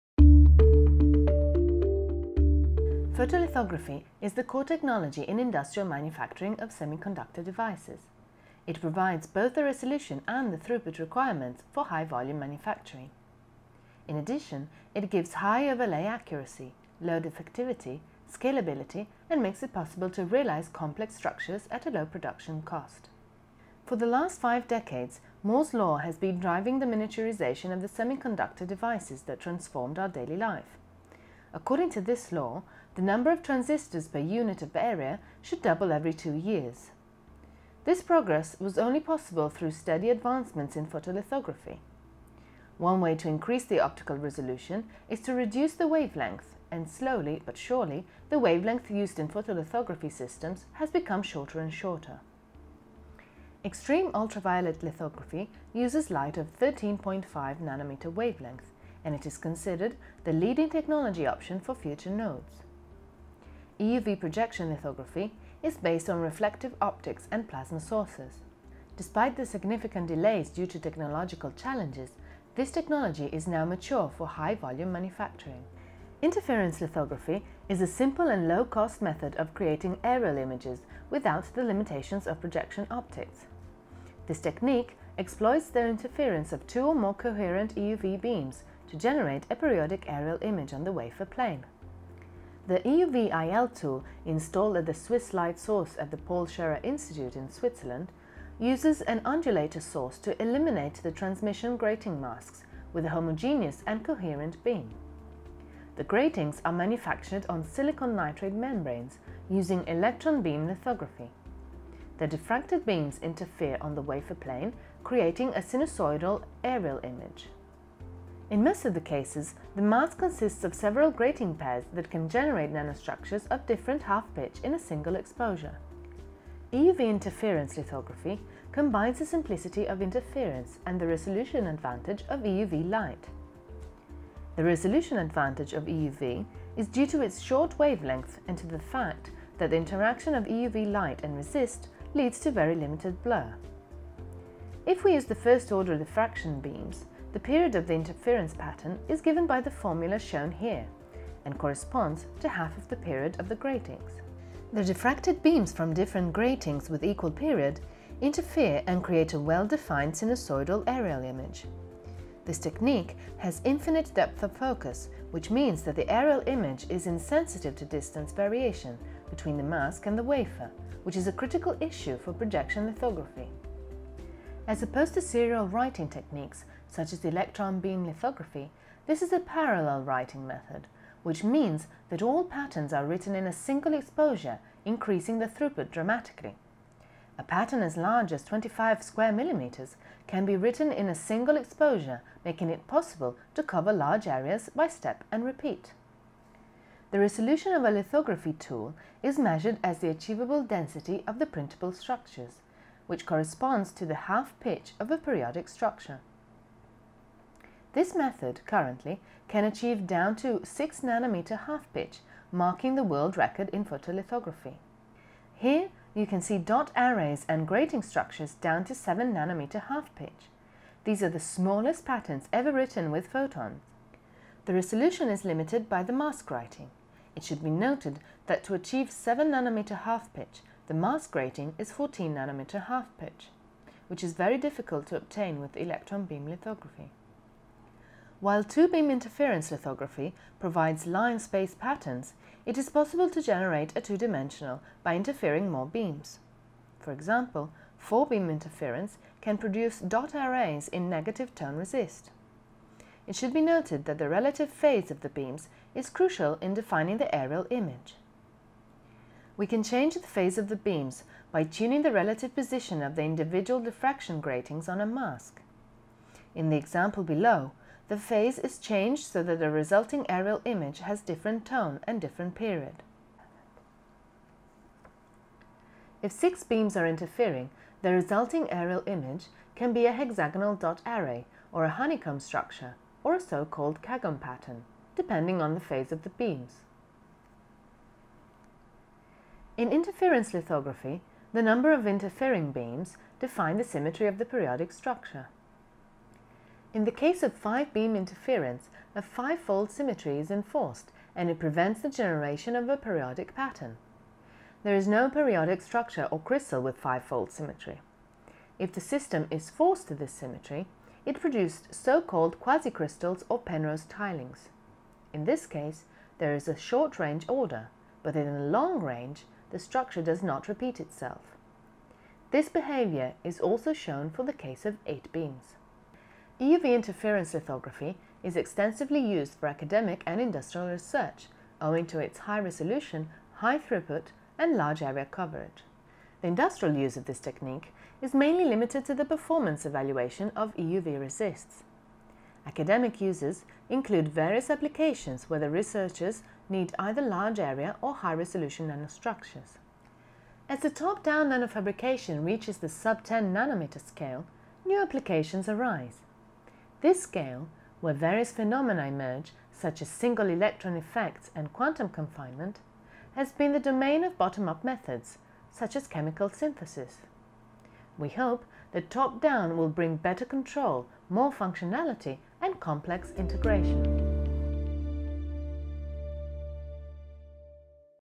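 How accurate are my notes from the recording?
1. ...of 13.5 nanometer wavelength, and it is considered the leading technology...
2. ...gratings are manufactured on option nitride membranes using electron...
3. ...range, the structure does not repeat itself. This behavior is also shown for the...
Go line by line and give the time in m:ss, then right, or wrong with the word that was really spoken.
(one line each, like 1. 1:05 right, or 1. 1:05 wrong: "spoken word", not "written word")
1. 0:56 right
2. 1:46 wrong: "silicon", not "option"
3. 5:19 right.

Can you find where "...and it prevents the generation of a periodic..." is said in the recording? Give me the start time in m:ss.
5:01.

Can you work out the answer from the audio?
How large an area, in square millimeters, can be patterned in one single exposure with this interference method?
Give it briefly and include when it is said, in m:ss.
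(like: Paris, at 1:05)
25 square millimeters, at 3:08.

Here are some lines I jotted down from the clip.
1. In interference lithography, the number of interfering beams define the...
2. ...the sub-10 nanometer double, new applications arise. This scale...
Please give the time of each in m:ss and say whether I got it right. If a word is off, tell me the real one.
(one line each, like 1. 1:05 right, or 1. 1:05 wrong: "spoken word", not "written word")
1. 4:49 right
2. 5:52 wrong: "scale", not "double".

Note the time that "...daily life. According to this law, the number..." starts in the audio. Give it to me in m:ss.
0:30.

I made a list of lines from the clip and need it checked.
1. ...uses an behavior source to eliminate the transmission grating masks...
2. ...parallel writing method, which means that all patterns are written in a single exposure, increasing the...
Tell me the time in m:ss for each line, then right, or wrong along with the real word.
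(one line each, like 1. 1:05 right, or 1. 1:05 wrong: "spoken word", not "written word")
1. 1:38 wrong: "undulator", not "behavior"
2. 2:59 right.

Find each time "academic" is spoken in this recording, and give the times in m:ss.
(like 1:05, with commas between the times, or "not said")
5:29, 5:42.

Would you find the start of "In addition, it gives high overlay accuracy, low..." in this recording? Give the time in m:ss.
0:14.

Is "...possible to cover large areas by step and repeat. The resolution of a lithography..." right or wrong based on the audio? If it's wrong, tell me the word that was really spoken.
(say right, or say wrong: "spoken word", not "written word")
right.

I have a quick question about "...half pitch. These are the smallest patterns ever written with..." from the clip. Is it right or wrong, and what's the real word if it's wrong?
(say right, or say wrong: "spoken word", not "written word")
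right.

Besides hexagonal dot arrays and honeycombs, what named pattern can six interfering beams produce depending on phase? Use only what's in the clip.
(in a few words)
Kagome pattern.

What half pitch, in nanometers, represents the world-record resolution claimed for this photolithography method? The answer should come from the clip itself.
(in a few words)
6 nanometers.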